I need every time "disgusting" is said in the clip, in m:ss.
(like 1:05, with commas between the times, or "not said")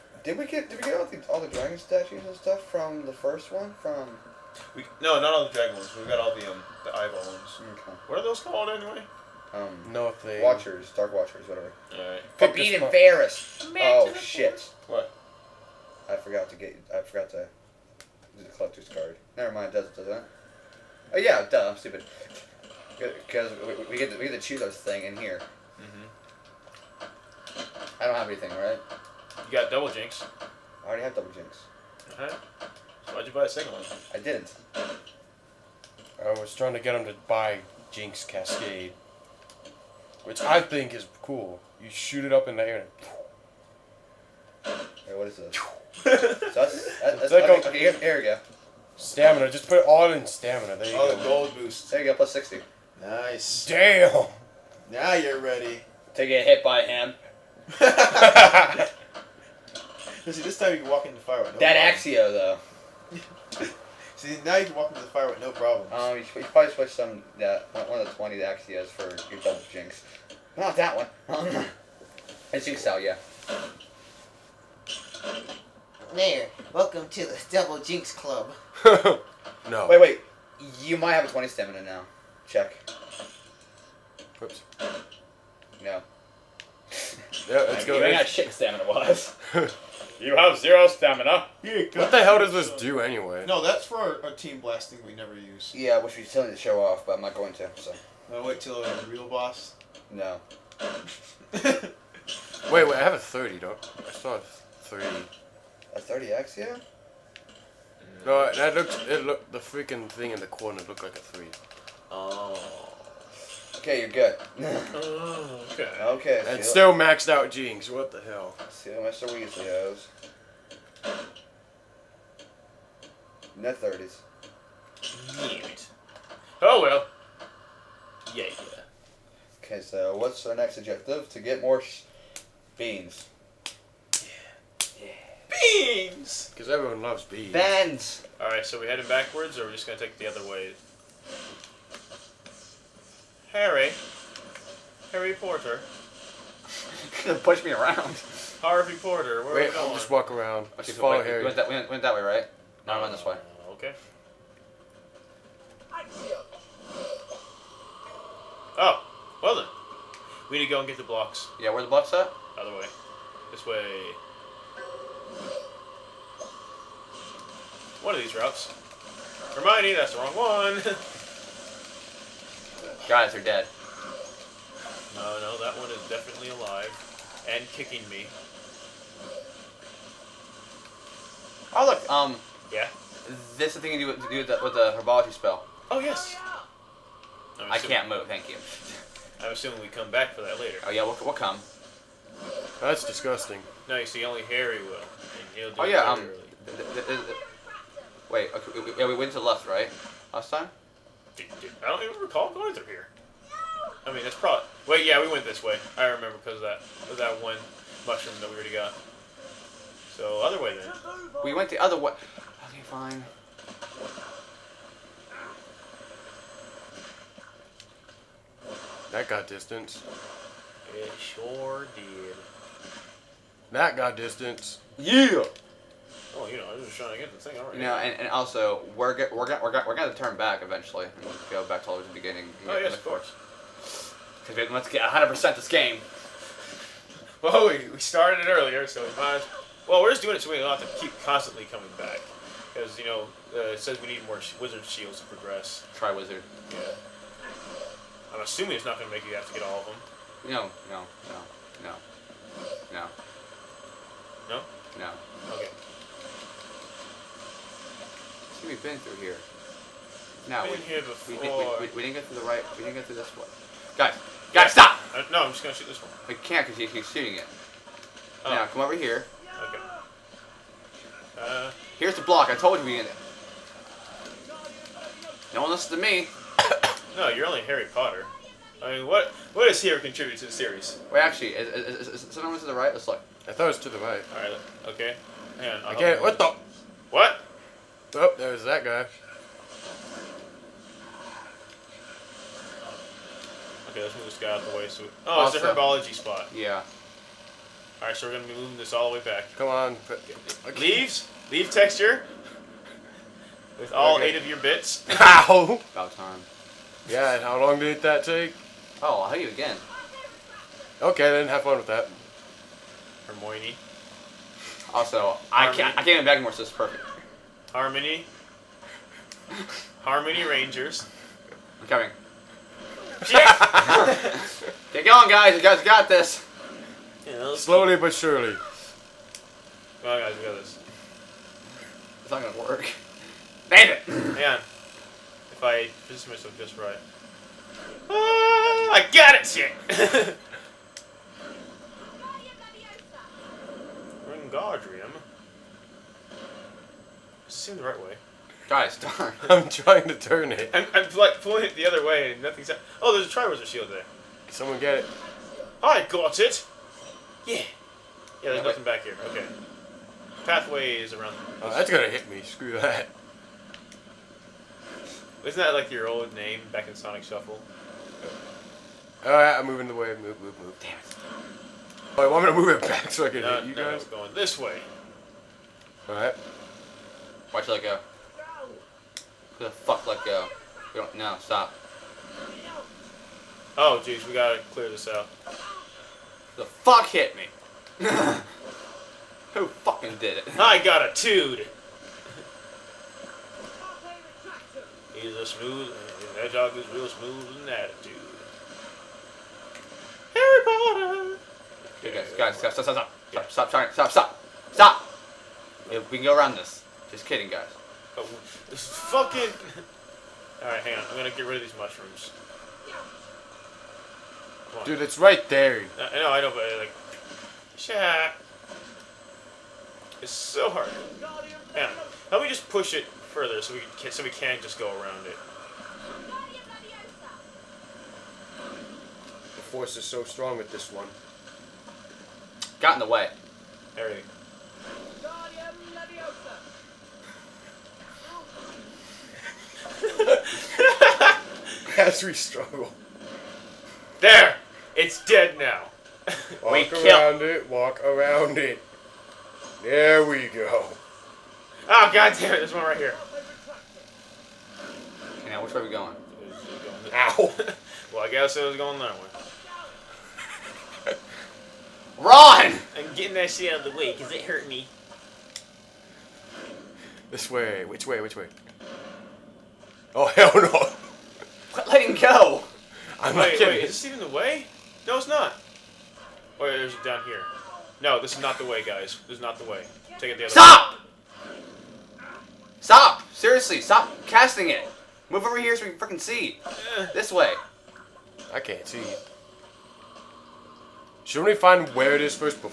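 3:13.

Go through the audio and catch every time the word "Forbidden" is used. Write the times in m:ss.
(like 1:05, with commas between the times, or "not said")
0:12.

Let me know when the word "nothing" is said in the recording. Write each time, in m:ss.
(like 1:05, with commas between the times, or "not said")
5:52, 5:58.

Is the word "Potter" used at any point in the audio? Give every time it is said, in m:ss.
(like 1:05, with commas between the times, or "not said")
4:37, 6:40.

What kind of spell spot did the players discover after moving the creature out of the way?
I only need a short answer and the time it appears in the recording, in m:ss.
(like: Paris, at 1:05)
Herbology spot, at 4:55.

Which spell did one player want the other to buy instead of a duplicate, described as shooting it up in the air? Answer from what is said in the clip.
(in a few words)
Jinx Cascade.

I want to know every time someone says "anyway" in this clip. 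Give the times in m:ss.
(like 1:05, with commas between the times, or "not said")
0:08, 1:33.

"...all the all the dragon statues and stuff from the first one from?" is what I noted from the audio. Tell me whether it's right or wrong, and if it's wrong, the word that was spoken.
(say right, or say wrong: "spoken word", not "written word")
right.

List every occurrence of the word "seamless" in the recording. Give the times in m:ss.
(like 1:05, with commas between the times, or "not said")
not said.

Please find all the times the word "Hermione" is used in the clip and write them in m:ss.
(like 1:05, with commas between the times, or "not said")
2:49, 5:13.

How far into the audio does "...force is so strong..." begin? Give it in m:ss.
7:09.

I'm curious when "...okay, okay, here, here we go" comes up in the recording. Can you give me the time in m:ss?
0:47.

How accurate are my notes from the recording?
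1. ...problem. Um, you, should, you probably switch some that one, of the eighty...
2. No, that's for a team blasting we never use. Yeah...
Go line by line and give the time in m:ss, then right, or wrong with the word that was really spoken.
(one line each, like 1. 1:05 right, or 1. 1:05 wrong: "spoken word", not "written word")
1. 1:05 wrong: "twenty", not "eighty"
2. 1:33 right.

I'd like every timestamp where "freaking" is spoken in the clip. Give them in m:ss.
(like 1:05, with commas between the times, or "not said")
1:49, 8:05.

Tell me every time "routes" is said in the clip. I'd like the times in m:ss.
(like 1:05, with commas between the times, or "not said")
2:48.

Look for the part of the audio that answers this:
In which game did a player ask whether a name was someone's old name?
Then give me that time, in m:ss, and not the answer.
6:06.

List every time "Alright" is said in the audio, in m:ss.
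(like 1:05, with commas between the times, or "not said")
0:11, 6:09, 6:16.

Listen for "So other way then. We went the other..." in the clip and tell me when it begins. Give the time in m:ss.
3:30.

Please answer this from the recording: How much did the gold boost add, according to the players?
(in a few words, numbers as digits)
60.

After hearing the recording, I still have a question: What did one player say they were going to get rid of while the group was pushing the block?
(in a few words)
Mushrooms.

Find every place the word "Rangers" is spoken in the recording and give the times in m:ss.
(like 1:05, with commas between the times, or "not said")
5:20.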